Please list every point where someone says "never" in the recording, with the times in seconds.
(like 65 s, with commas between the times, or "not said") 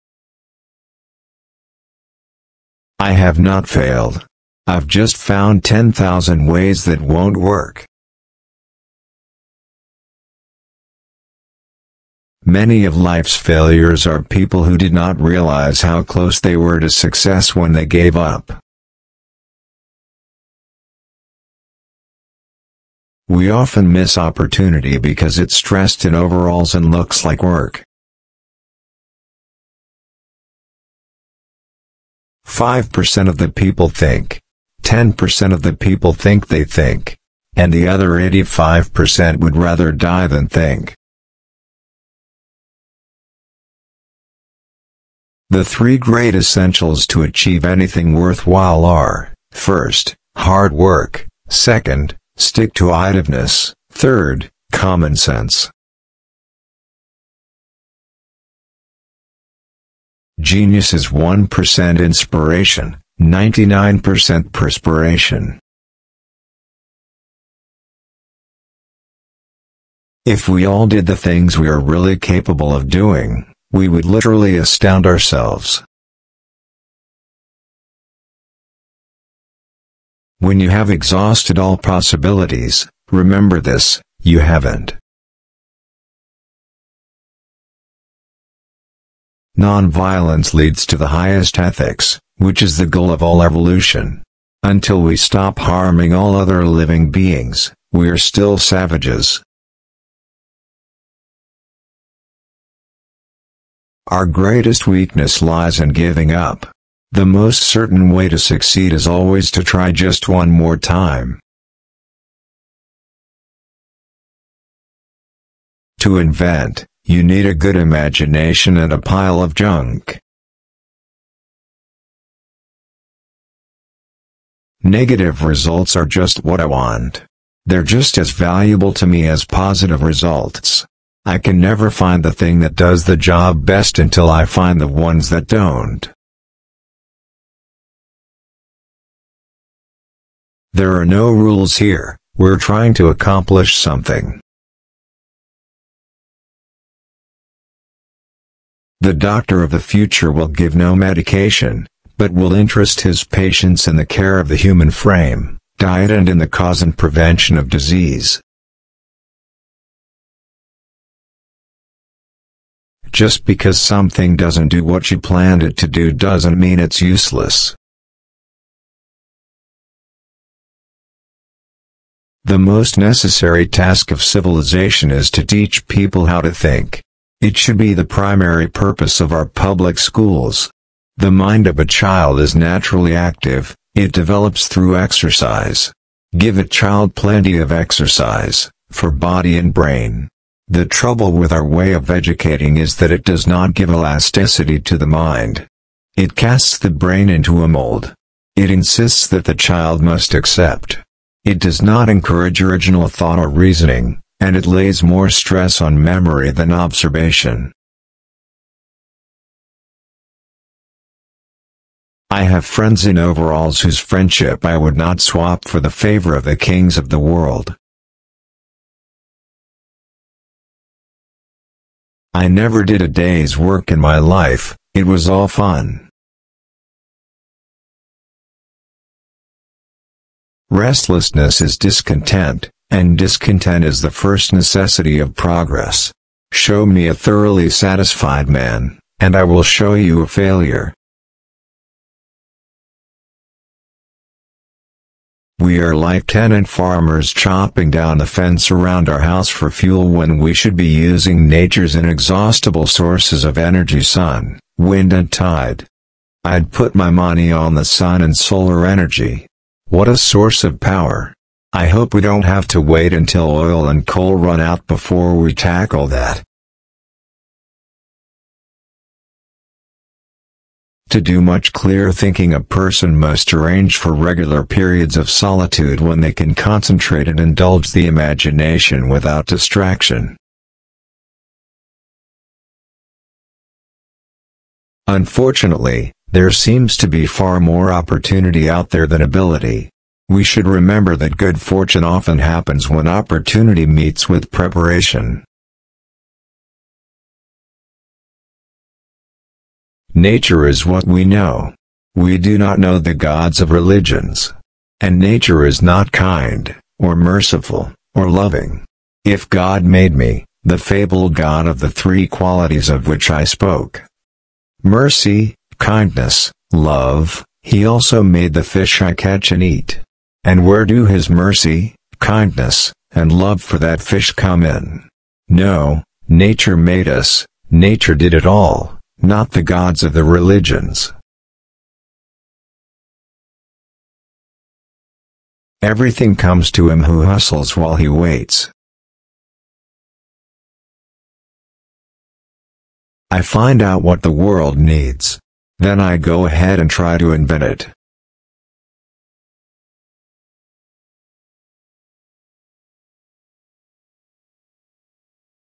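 131 s, 222 s.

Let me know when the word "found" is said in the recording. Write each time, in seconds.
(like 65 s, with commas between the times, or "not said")
5 s.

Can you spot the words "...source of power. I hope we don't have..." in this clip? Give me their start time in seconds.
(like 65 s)
260 s.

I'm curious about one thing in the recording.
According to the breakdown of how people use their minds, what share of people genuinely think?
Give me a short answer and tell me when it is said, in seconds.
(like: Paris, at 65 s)
5%, at 32 s.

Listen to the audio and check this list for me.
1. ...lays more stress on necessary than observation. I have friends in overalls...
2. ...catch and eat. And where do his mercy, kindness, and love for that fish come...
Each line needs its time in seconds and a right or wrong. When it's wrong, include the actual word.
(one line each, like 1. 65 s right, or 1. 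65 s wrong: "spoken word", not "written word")
1. 204 s wrong: "memory", not "necessary"
2. 319 s right.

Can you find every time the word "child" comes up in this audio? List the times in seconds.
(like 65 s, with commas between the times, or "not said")
181 s, 186 s, 199 s.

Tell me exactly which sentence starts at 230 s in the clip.
Restlessness is discontent, and discontent is the first necessity of progress.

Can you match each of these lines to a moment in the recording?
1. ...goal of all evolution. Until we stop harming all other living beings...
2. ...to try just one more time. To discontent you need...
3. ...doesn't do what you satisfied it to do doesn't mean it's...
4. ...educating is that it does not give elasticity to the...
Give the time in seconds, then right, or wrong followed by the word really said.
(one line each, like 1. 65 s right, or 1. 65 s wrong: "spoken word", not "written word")
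1. 92 s right
2. 109 s wrong: "invent", not "discontent"
3. 164 s wrong: "planned", not "satisfied"
4. 192 s right.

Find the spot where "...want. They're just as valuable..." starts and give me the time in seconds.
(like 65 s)
126 s.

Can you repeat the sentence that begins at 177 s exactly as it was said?
It should be the primary purpose of our public schools.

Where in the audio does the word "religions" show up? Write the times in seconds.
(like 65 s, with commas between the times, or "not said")
303 s, 330 s.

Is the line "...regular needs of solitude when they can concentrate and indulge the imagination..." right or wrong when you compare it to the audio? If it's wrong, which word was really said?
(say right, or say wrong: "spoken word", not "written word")
wrong: "periods", not "needs".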